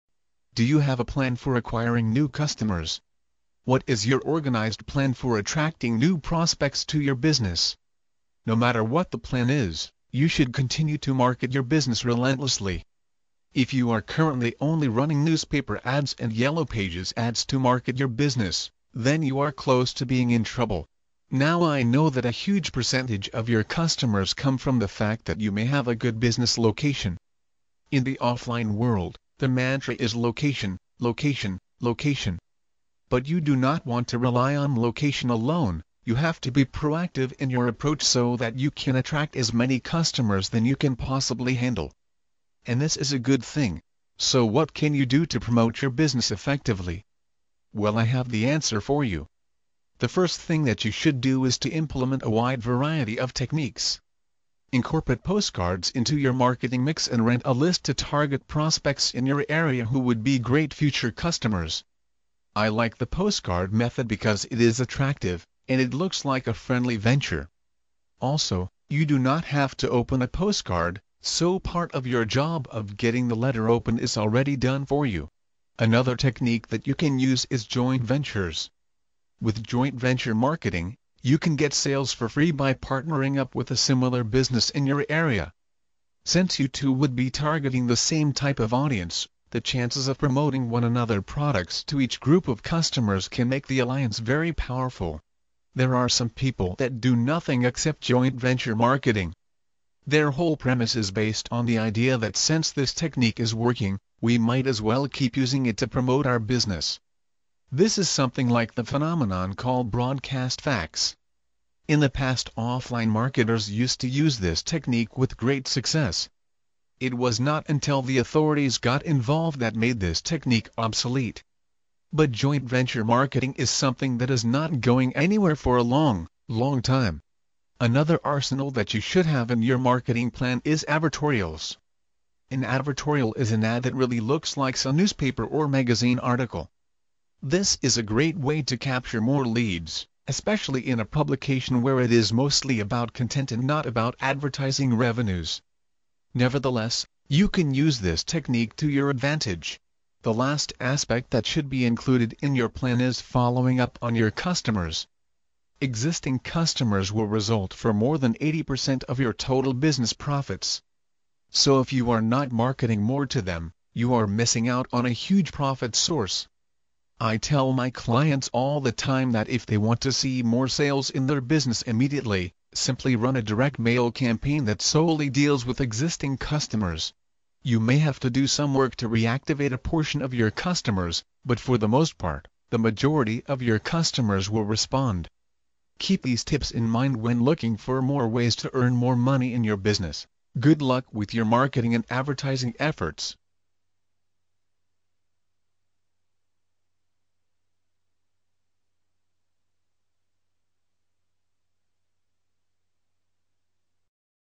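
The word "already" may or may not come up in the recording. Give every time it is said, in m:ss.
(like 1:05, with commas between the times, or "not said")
1:14.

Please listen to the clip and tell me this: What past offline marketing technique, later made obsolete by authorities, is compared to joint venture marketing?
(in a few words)
broadcast fax.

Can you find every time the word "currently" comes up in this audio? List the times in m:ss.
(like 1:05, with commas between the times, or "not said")
0:14.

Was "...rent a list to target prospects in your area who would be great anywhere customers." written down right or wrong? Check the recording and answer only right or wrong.
wrong.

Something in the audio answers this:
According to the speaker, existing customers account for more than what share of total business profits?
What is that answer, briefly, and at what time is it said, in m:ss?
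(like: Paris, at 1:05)
80%, at 2:38.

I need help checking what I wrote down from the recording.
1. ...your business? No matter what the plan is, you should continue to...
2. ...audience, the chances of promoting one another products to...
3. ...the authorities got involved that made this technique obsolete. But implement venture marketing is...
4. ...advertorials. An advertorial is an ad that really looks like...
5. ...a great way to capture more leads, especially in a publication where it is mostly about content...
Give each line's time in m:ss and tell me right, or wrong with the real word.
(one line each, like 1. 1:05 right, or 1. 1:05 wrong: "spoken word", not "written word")
1. 0:06 right
2. 1:28 right
3. 1:58 wrong: "joint", not "implement"
4. 2:10 right
5. 2:17 right.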